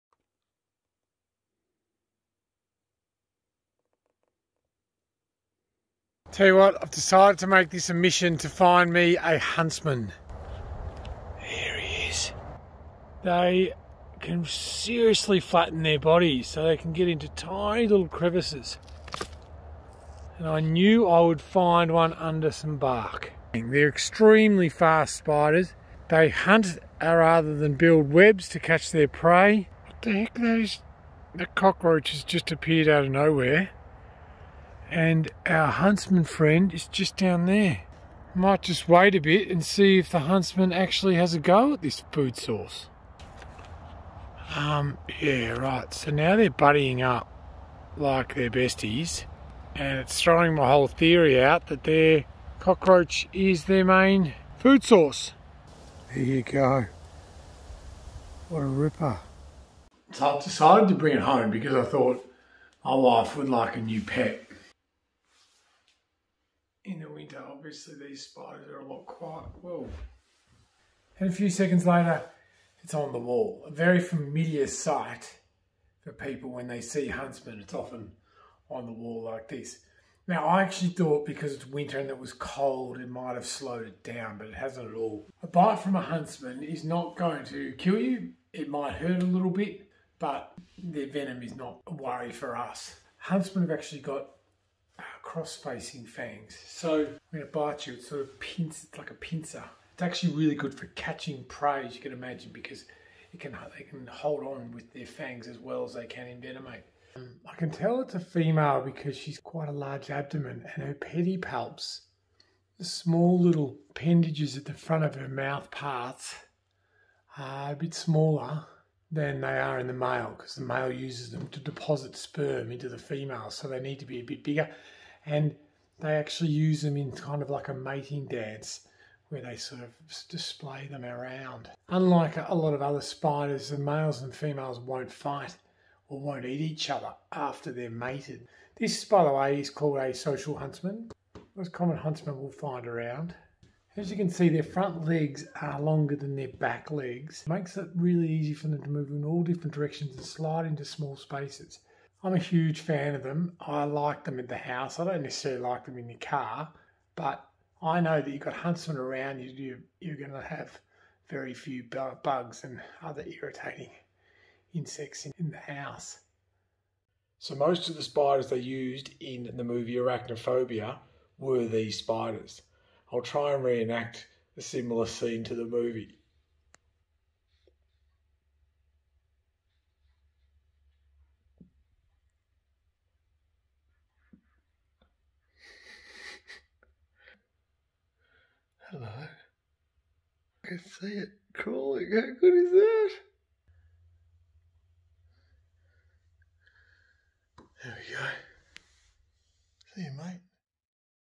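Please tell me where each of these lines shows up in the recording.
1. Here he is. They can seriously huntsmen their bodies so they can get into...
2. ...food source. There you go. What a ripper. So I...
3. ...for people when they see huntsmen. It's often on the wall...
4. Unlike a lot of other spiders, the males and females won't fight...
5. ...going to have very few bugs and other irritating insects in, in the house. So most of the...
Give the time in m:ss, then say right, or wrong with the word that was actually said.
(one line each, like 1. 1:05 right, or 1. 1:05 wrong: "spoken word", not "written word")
1. 0:11 wrong: "flatten", not "huntsmen"
2. 0:54 right
3. 1:16 right
4. 2:11 right
5. 2:40 right.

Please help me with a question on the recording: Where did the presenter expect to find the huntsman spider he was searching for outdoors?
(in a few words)
Under some bark.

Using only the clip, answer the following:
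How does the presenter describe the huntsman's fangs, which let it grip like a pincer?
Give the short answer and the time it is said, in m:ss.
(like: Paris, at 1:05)
Cross-facing, at 1:35.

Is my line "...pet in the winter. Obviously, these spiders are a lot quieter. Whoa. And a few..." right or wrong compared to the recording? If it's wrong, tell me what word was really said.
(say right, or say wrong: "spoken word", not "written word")
right.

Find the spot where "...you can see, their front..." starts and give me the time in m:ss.
2:24.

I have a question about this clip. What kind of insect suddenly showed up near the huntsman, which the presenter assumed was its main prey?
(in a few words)
Cockroaches.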